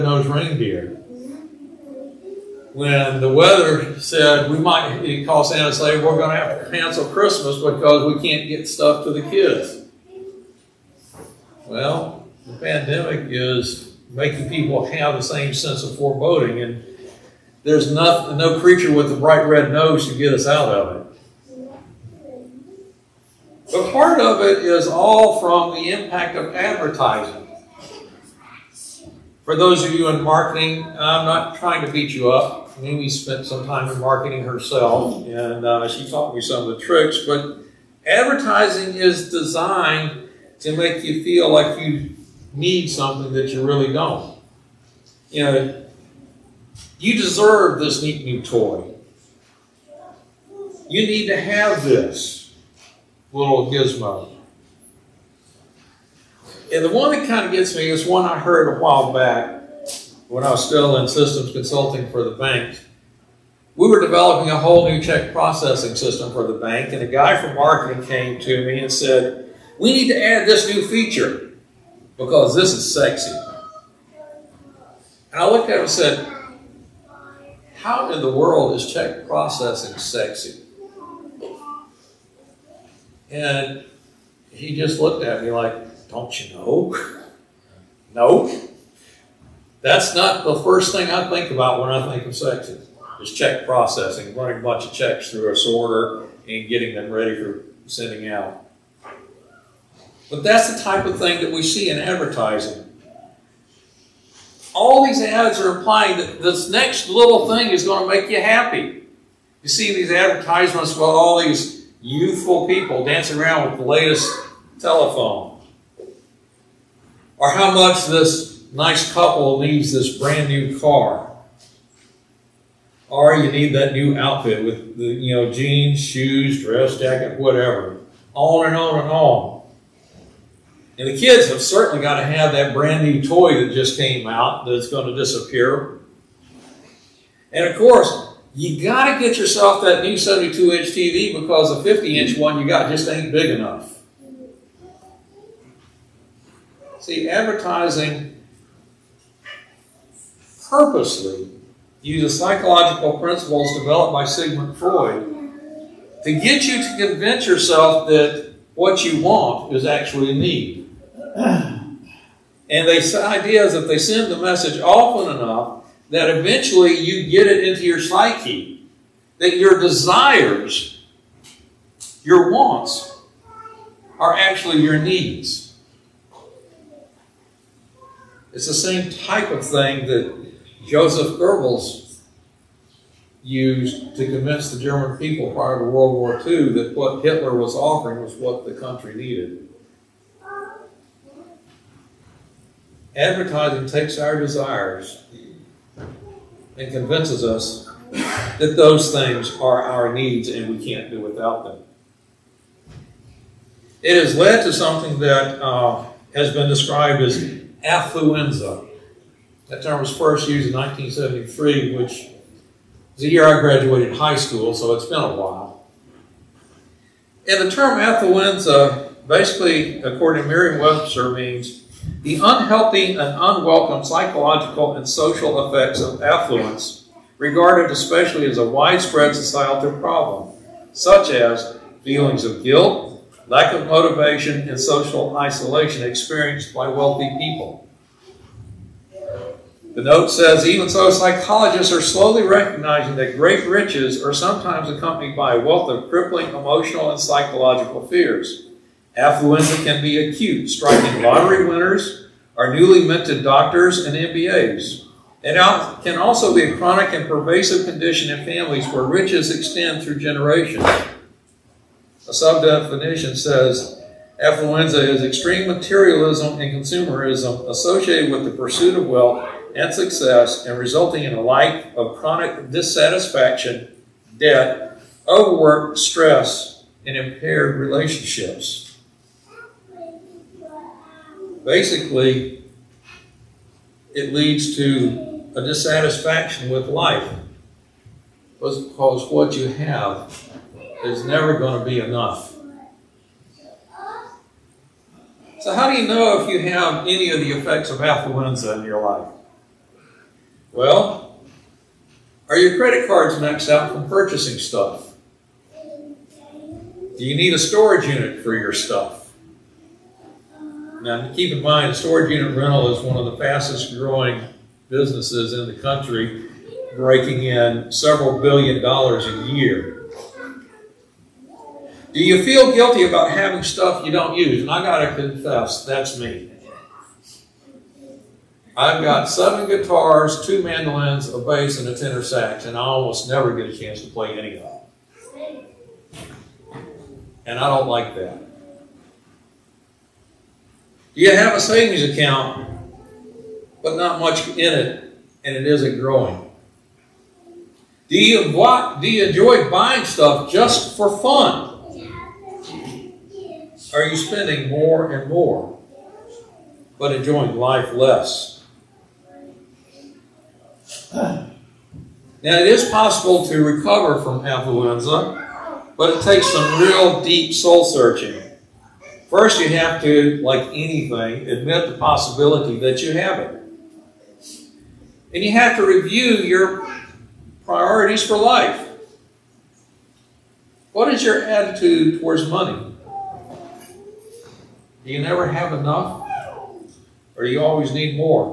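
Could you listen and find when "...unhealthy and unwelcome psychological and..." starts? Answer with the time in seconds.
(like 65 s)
222 s.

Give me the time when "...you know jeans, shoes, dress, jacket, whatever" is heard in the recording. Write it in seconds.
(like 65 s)
125 s.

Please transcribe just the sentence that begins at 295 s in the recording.
So, how do you know if you have any of the effects of affluenza in your life?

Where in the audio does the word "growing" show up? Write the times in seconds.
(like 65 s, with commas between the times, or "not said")
313 s, 345 s.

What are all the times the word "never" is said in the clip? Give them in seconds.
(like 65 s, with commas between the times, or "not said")
291 s, 333 s, 385 s.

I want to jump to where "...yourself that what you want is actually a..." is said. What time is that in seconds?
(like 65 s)
157 s.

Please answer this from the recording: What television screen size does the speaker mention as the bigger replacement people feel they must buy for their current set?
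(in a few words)
72 inch.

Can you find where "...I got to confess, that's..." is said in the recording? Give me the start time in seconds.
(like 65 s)
324 s.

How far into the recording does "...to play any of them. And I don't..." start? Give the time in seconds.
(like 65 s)
334 s.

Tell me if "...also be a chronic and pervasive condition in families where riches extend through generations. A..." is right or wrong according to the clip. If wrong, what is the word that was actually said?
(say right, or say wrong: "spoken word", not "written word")
right.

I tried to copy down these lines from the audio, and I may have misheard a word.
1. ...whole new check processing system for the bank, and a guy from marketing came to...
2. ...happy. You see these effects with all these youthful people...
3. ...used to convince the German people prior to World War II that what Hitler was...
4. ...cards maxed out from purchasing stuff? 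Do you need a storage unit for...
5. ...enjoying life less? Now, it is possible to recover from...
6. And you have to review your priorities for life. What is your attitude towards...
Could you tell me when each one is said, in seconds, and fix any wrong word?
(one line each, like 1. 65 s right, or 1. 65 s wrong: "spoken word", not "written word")
1. 64 s right
2. 108 s wrong: "advertisements", not "effects"
3. 183 s right
4. 303 s right
5. 357 s right
6. 375 s right.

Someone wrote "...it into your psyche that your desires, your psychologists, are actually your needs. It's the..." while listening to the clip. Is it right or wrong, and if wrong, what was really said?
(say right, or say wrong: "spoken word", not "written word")
wrong: "wants", not "psychologists".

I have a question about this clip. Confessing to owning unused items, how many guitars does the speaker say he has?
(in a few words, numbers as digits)
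7.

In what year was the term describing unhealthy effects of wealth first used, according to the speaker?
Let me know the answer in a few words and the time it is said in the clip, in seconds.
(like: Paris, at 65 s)
1973, at 210 s.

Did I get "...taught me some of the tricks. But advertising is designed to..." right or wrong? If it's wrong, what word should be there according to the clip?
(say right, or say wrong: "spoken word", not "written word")
right.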